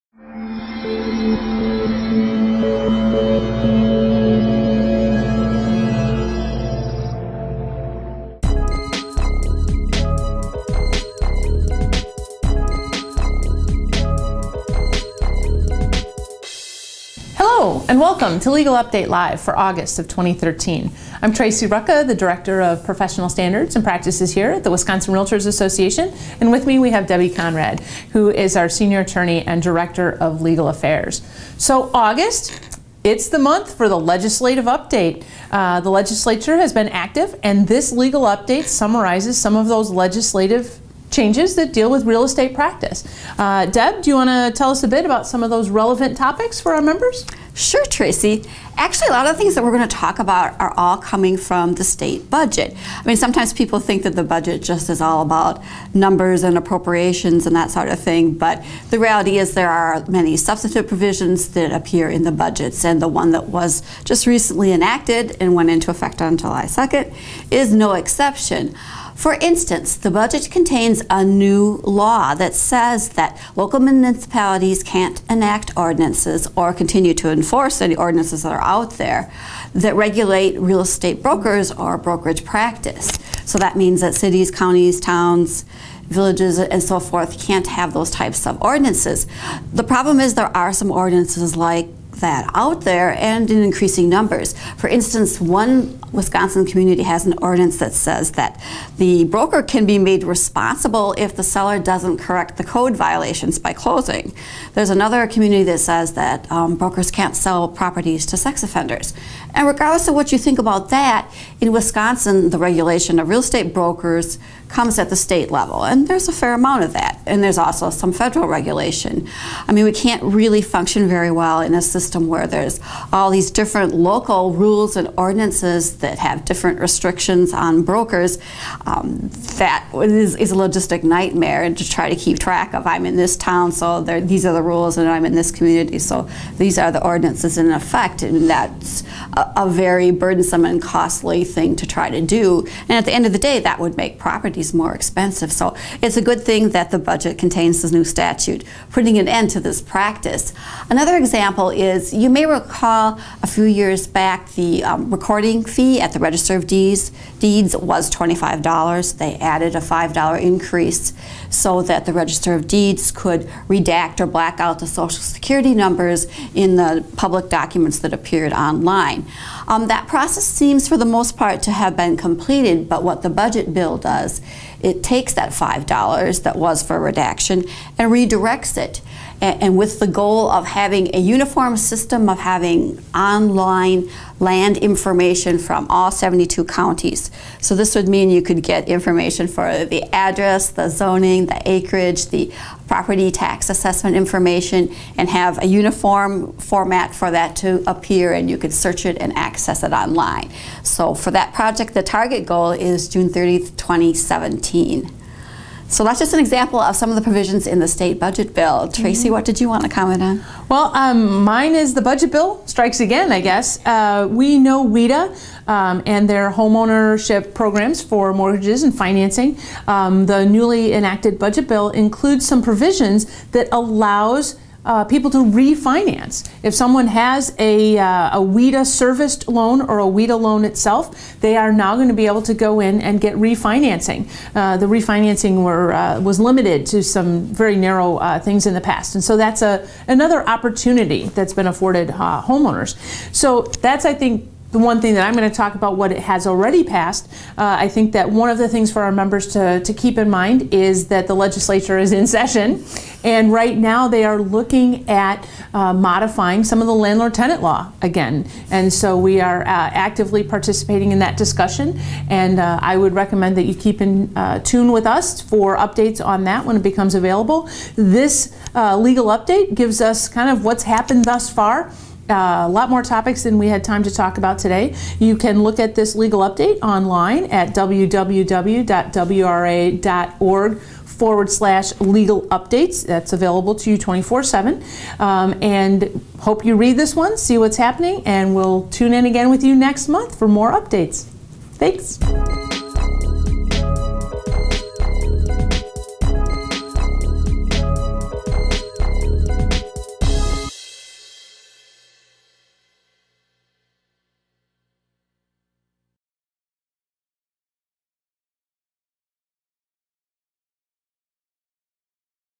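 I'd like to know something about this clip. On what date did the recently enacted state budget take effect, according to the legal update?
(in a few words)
July 2nd.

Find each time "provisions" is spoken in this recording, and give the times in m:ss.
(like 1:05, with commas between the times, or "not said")
1:00, 3:27, 3:42.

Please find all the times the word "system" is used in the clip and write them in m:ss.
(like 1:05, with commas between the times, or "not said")
2:01, 3:01.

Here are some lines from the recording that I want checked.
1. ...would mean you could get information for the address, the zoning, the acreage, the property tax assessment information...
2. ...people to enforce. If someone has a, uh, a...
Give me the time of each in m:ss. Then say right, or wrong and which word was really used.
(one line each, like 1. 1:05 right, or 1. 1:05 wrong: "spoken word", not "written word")
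1. 3:07 right
2. 3:45 wrong: "refinance", not "enforce".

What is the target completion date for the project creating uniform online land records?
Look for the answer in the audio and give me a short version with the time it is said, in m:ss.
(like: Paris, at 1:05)
June 30th, 2017, at 3:23.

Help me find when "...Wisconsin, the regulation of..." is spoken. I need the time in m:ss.
1:51.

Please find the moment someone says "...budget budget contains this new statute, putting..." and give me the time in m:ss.
2:26.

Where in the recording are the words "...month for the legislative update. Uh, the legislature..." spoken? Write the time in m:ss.
0:33.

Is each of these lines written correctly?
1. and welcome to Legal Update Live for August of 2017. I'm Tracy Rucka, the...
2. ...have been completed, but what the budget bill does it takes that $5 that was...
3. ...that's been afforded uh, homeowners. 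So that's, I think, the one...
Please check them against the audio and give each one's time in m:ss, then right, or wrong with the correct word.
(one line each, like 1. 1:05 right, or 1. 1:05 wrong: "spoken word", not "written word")
1. 0:17 wrong: "2013", not "2017"
2. 2:51 right
3. 4:01 right.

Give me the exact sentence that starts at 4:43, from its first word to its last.
That's available to you 24 7.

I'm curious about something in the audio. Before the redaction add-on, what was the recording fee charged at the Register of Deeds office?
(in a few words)
$25.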